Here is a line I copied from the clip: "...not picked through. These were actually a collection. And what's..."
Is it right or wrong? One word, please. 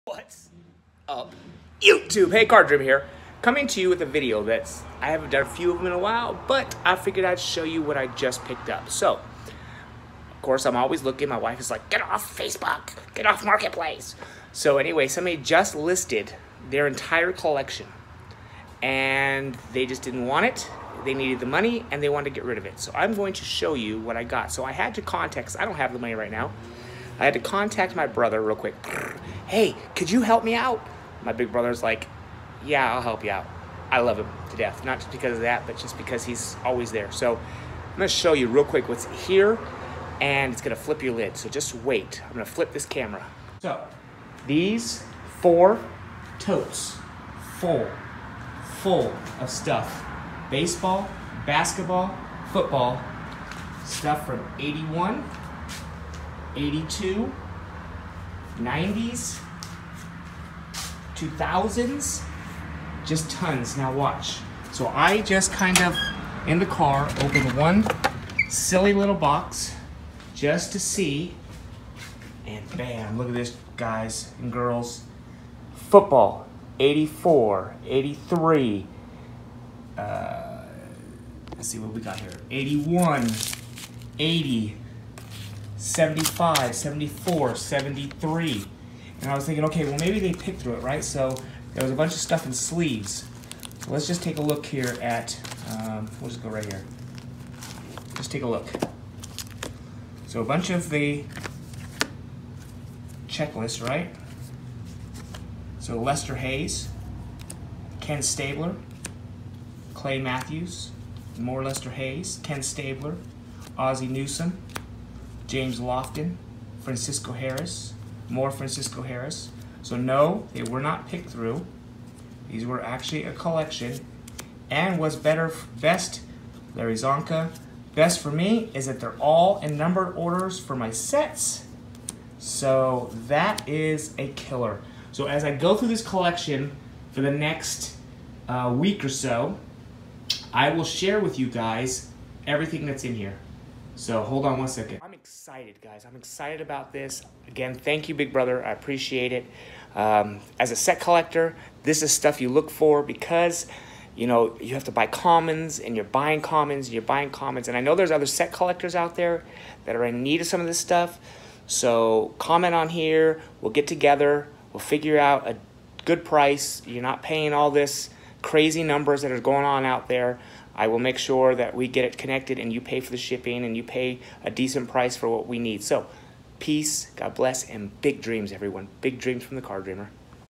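right.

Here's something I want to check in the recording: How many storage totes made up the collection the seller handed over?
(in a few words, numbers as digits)
4.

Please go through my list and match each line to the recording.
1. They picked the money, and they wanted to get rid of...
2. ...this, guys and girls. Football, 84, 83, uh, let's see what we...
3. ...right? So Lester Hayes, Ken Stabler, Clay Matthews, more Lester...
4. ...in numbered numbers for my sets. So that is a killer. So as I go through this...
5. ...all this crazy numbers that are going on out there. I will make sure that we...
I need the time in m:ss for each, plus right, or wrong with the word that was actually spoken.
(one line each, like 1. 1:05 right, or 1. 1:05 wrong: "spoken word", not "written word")
1. 0:21 wrong: "needed", not "picked"
2. 1:13 right
3. 1:43 right
4. 2:09 wrong: "orders", not "numbers"
5. 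2:47 right.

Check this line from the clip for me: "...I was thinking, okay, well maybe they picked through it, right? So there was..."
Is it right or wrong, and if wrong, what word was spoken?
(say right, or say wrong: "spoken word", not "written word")
right.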